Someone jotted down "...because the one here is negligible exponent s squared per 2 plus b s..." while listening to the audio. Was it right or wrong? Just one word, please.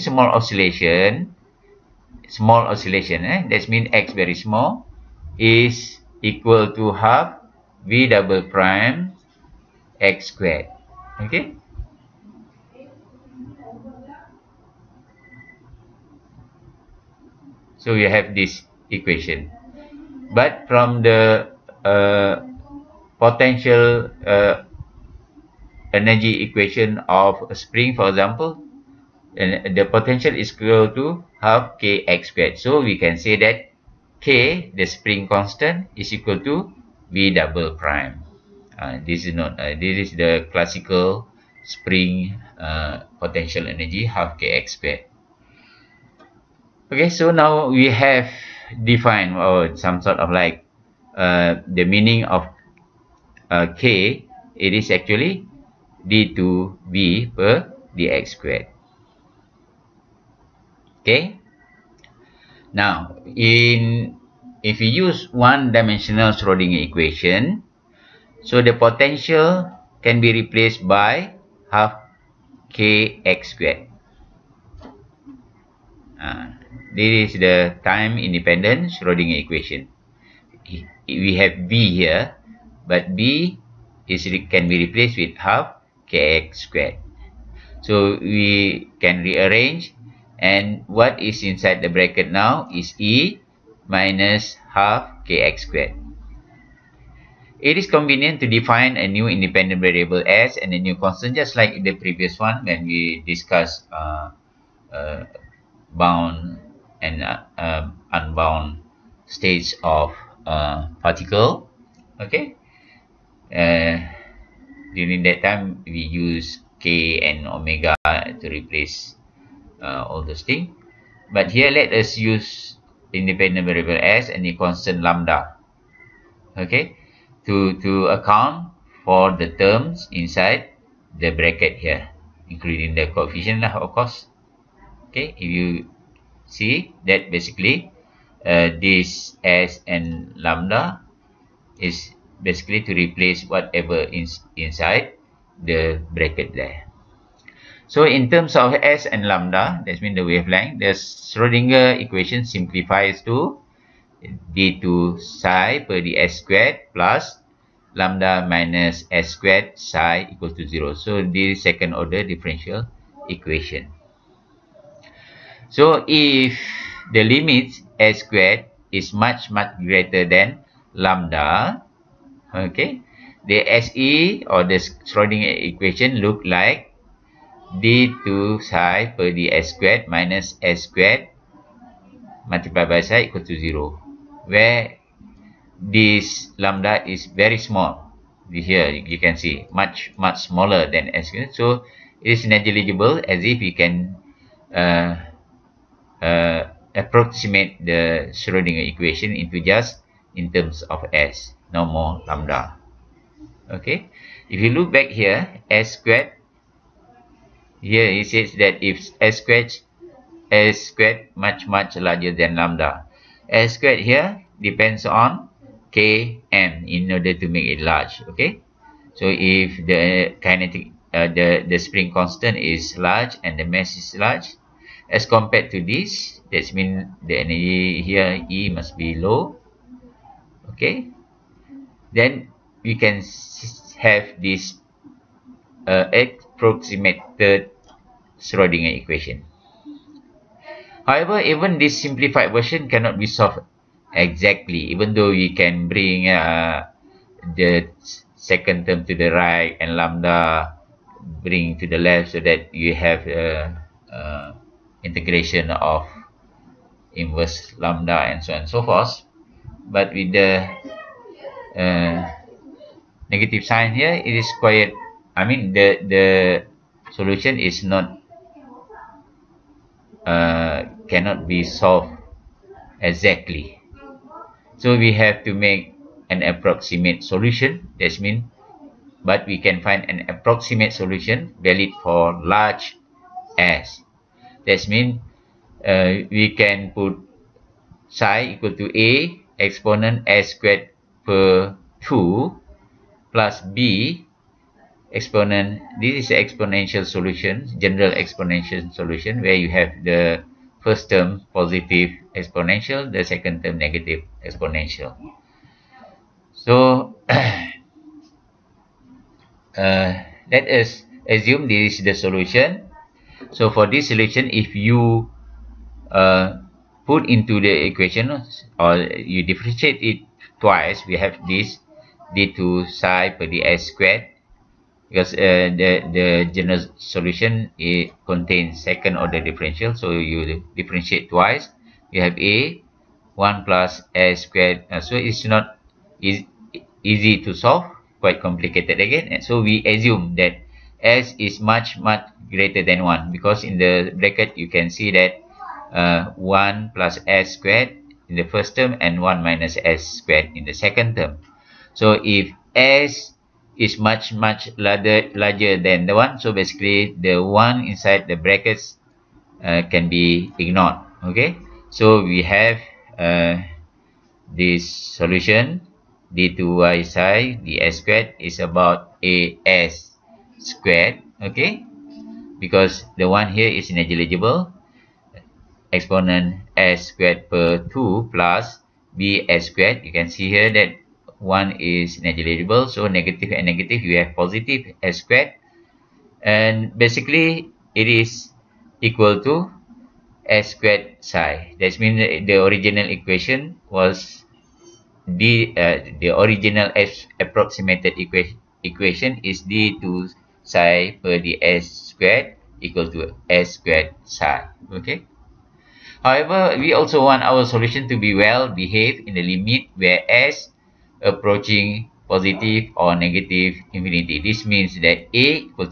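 right.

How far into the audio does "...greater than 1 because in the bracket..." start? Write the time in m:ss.
5:42.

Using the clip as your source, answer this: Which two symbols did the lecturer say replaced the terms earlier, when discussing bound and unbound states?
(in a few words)
k and omega.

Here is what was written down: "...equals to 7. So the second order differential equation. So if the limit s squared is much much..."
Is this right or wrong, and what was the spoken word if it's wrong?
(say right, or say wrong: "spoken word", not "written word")
wrong: "0", not "7".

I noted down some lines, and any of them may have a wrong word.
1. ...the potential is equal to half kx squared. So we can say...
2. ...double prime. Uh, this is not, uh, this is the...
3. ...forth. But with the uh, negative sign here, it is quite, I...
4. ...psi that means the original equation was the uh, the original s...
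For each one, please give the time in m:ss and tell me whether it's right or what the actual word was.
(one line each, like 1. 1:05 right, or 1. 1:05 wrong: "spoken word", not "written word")
1. 0:29 right
2. 0:37 right
3. 4:18 right
4. 6:31 right.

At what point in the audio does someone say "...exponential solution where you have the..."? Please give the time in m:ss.
4:58.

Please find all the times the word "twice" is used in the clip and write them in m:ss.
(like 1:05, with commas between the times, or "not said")
5:20, 5:31.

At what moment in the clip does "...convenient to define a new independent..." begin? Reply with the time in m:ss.
1:37.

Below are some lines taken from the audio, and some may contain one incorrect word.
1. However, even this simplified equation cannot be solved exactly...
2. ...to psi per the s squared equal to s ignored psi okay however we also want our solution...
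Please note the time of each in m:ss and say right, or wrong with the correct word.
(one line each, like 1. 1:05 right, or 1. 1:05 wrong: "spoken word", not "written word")
1. 4:01 wrong: "version", not "equation"
2. 6:39 wrong: "squared", not "ignored".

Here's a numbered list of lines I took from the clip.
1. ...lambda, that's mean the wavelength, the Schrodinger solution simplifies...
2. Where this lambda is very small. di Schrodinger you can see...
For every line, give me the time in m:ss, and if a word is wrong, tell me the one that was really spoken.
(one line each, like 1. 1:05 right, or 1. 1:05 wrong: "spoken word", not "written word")
1. 2:29 wrong: "equation", not "solution"
2. 3:04 wrong: "Here", not "Schrodinger".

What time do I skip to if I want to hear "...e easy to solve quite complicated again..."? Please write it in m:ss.
5:36.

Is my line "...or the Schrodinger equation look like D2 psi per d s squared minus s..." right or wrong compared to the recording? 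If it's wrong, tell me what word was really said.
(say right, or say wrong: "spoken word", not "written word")
right.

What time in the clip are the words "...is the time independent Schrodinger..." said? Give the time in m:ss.
1:17.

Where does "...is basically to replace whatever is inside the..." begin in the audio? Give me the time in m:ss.
2:21.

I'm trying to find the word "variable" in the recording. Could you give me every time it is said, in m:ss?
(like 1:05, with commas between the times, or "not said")
1:39, 2:03.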